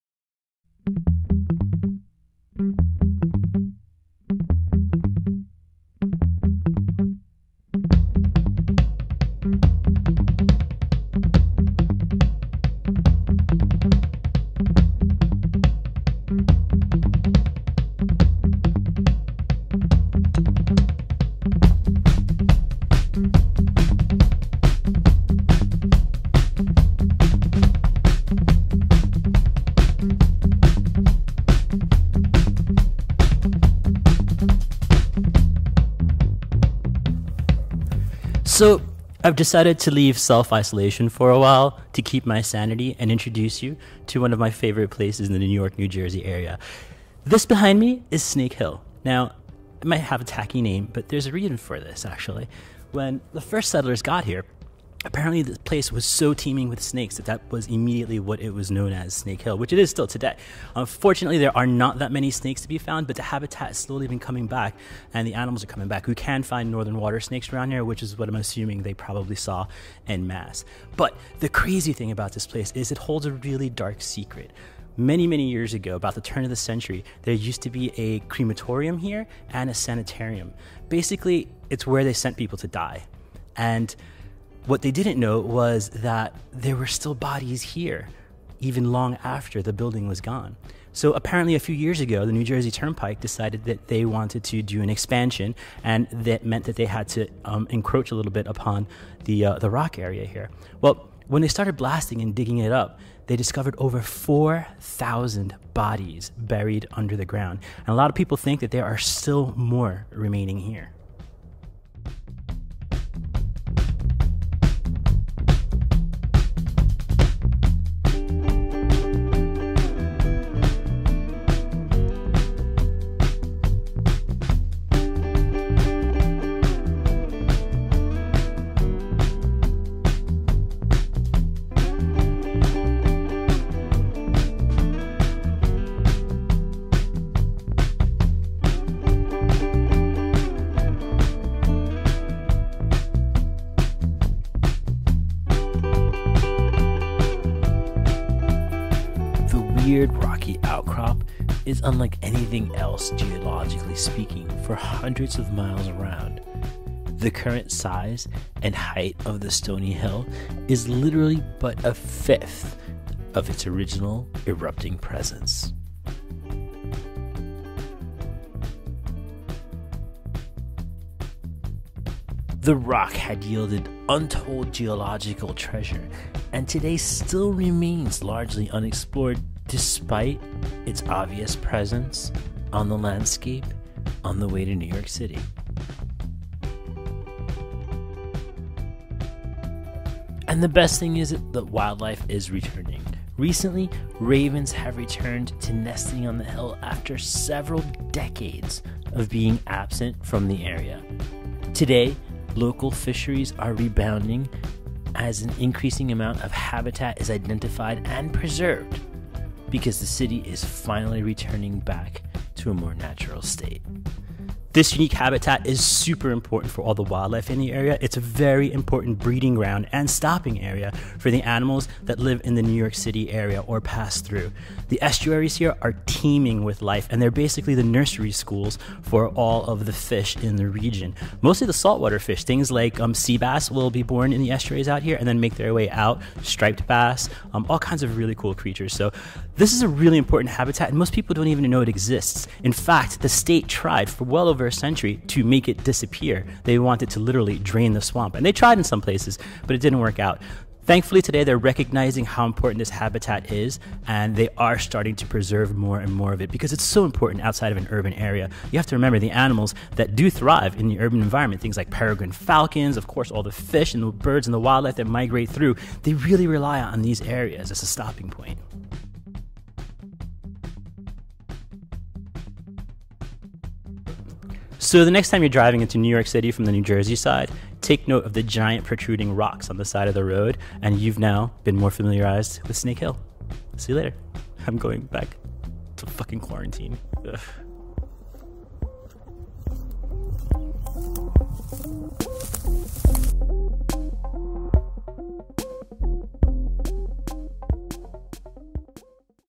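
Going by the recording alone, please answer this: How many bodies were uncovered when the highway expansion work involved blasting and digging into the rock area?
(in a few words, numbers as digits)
over 4,000.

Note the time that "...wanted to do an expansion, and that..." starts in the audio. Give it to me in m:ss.
1:34.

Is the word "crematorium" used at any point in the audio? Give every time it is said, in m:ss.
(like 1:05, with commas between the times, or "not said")
1:18.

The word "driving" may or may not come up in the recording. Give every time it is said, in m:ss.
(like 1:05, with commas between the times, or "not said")
4:35.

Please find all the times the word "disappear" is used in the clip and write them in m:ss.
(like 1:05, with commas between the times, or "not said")
4:05.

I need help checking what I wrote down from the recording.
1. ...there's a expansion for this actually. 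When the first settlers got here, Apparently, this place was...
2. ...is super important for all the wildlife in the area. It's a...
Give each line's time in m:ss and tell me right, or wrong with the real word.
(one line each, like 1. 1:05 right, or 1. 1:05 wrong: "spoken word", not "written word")
1. 0:51 wrong: "reason", not "expansion"
2. 3:35 right.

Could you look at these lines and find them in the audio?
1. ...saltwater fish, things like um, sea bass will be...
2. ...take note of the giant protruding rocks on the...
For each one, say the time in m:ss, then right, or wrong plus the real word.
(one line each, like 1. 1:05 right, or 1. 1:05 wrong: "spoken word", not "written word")
1. 3:51 right
2. 4:37 right.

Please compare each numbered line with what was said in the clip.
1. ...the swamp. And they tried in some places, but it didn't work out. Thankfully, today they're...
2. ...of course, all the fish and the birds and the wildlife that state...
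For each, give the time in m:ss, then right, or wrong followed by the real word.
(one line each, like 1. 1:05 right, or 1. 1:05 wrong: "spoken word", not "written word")
1. 4:07 right
2. 4:22 wrong: "migrate", not "state".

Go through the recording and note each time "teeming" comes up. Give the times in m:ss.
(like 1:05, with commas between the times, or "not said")
0:56, 3:46.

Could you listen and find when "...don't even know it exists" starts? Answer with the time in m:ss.
4:01.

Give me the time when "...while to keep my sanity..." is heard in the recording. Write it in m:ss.
0:41.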